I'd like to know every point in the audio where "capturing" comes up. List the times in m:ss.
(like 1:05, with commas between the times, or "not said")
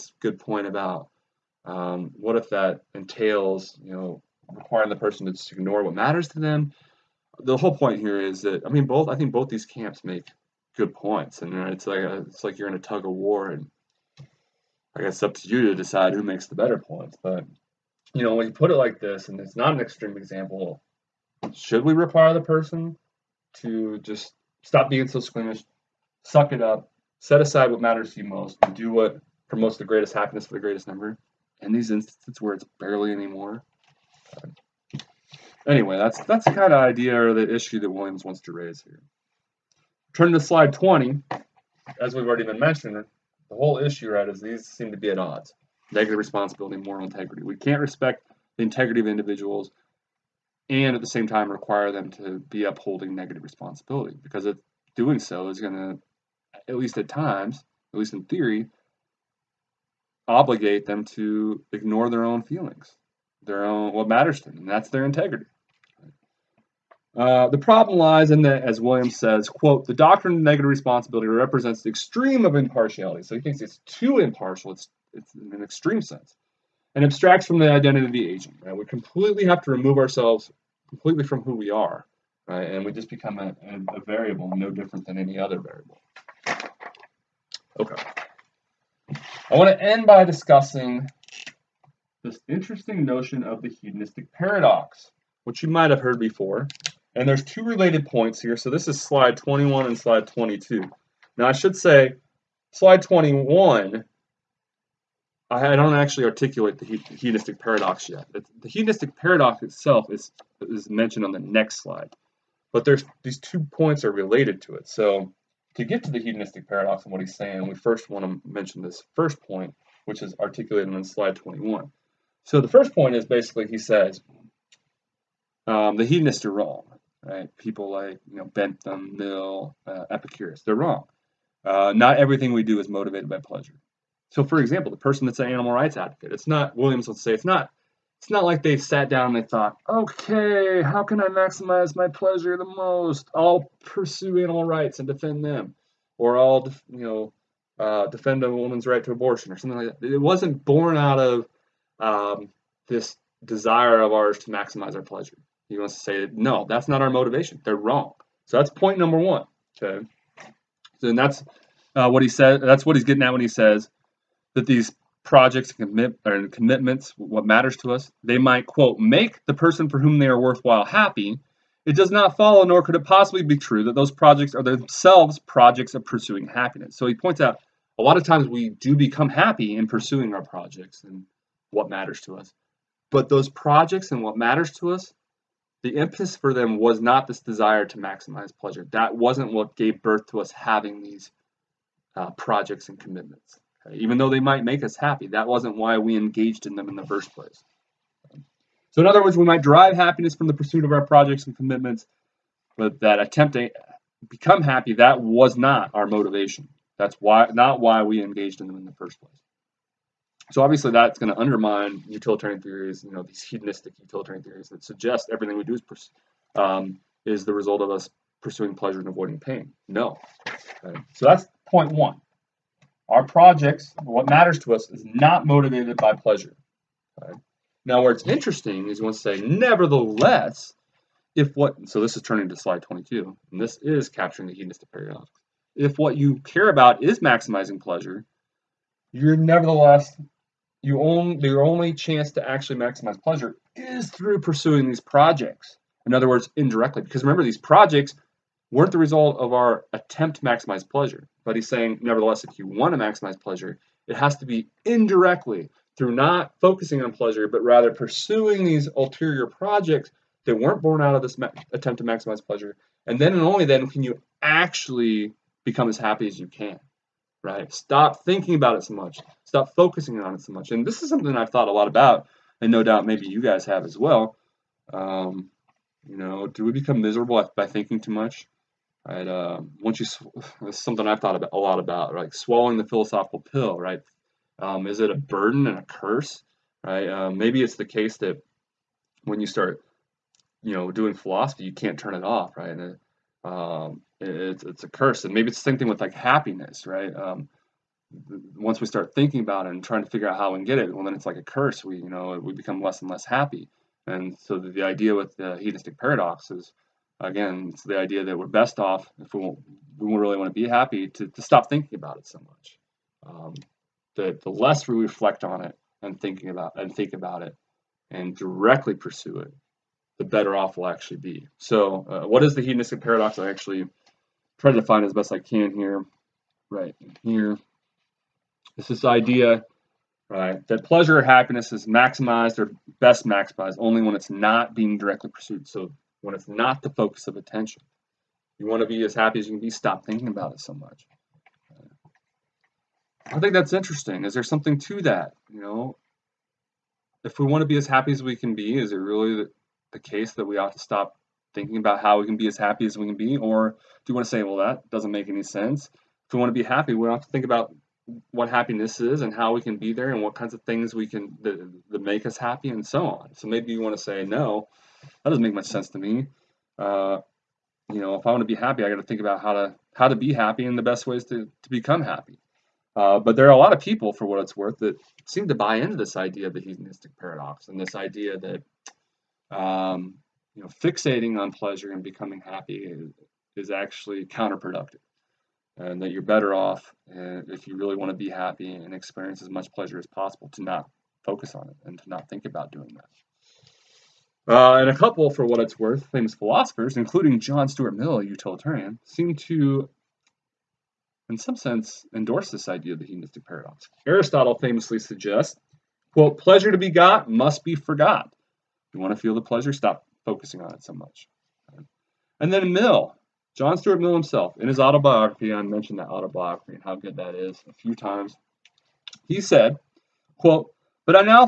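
3:54.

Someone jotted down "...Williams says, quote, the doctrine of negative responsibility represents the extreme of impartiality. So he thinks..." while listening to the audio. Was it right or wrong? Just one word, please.
right.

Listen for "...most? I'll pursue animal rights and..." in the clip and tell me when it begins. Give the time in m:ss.
2:22.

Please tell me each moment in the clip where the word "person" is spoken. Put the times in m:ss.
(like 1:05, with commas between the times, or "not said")
0:04, 0:22, 2:14, 2:49.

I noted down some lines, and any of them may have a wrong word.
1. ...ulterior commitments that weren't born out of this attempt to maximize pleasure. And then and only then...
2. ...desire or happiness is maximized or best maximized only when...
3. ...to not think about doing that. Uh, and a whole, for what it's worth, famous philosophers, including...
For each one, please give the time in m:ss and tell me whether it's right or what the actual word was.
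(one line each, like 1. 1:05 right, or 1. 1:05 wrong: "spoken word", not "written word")
1. 4:18 wrong: "projects", not "commitments"
2. 5:30 wrong: "pleasure", not "desire"
3. 6:32 wrong: "couple", not "whole".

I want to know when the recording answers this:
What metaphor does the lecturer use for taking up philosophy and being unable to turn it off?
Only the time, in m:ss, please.
4:42.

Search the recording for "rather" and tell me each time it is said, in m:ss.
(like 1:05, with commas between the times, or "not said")
4:17.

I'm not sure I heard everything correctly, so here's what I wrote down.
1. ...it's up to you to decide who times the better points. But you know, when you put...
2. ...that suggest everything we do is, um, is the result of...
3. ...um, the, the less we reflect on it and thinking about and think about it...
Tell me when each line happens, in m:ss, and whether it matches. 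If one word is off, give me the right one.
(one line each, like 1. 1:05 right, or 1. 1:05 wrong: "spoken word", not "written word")
1. 0:15 wrong: "makes", not "times"
2. 3:34 right
3. 5:13 right.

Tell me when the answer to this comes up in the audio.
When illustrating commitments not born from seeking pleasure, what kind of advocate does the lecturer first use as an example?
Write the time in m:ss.
2:15.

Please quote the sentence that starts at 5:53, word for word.
Or do you want to say, well, that doesn't make any sense?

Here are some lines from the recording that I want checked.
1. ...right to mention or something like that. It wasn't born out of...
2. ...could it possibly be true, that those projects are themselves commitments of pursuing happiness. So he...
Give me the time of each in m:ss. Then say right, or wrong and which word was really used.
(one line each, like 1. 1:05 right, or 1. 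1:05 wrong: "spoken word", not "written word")
1. 2:28 wrong: "abortion", not "mention"
2. 2:52 wrong: "projects", not "commitments".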